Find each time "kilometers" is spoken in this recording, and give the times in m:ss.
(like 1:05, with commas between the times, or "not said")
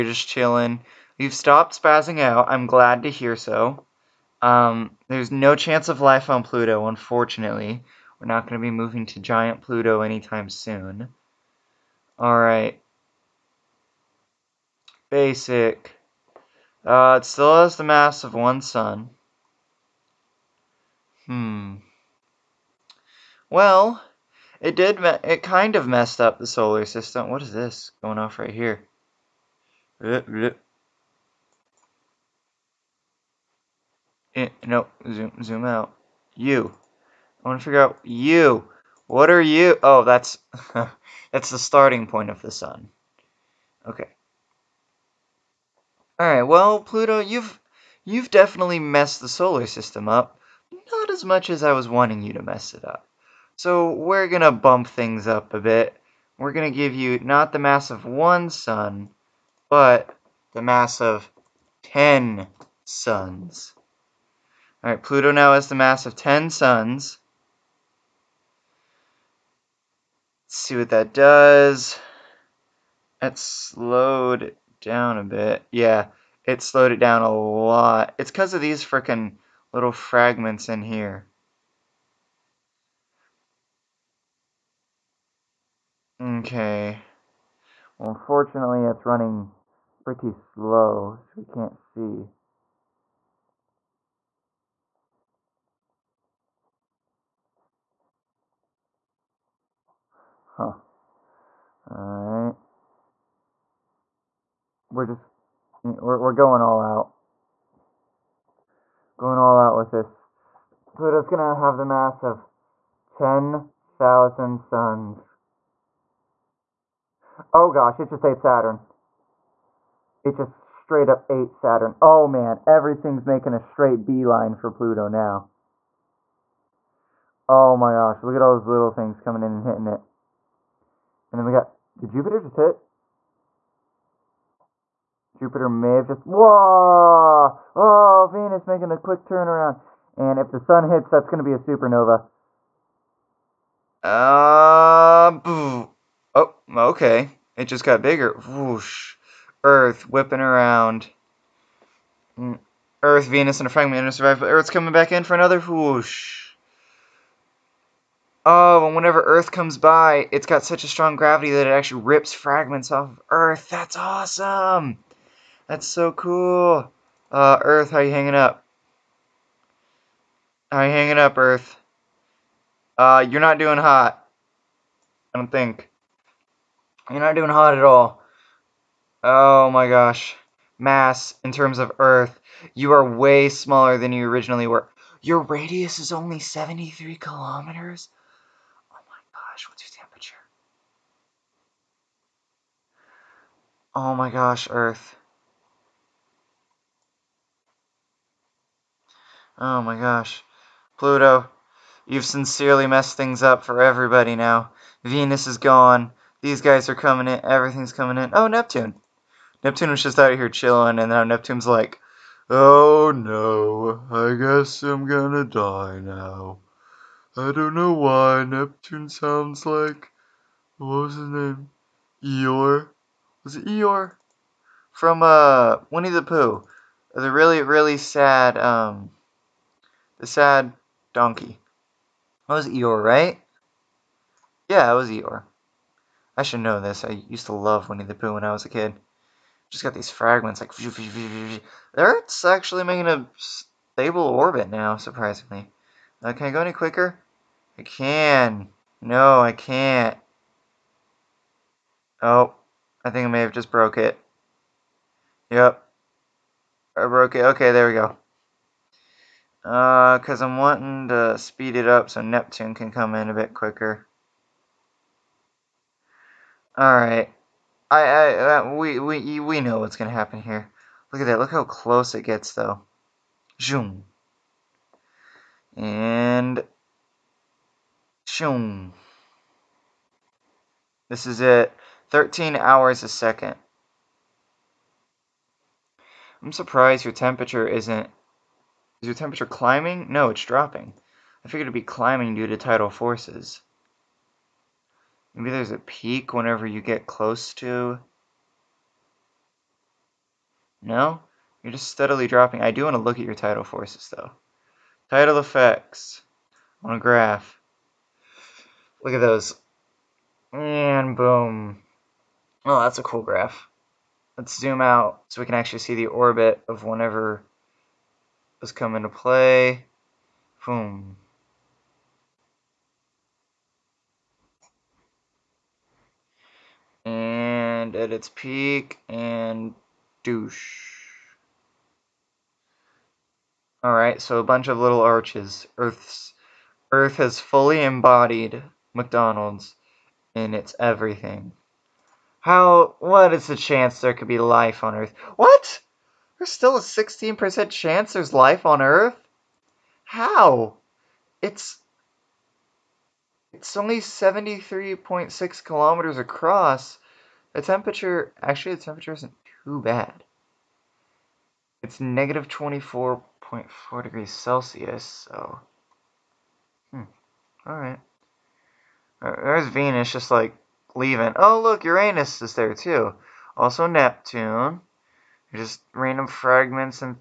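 3:07, 5:55.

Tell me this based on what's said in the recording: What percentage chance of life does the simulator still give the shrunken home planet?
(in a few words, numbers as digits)
16%.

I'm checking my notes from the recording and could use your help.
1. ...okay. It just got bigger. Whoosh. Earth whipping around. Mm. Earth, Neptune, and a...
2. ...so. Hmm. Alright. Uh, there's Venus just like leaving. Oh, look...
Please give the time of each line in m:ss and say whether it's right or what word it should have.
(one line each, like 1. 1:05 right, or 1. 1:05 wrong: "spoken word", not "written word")
1. 2:26 wrong: "Venus", not "Neptune"
2. 6:05 right.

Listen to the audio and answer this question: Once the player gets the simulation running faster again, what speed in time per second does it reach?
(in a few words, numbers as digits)
13 hours a second.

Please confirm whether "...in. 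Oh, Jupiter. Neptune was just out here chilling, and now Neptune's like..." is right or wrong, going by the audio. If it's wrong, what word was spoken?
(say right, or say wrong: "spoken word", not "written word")
wrong: "Neptune", not "Jupiter".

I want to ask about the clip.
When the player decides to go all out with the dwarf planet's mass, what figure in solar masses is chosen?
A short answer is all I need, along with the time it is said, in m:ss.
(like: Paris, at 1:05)
10,000, at 1:53.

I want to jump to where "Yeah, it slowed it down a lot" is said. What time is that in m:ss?
1:15.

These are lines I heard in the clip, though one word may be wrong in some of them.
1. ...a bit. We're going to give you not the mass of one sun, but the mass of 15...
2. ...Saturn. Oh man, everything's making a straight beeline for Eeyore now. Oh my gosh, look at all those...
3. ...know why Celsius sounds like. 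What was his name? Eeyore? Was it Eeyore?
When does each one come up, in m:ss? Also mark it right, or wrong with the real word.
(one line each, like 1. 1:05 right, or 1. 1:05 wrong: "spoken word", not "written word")
1. 0:55 wrong: "10", not "15"
2. 2:01 wrong: "Pluto", not "Eeyore"
3. 3:37 wrong: "Neptune", not "Celsius".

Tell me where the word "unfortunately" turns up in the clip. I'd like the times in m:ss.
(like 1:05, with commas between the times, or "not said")
0:06, 1:28.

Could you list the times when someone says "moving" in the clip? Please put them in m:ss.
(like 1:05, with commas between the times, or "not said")
0:08.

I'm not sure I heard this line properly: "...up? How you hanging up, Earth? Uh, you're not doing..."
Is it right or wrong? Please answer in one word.
right.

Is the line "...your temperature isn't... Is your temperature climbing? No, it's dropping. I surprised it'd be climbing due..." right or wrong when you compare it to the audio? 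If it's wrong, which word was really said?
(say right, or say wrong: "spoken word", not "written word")
wrong: "figured", not "surprised".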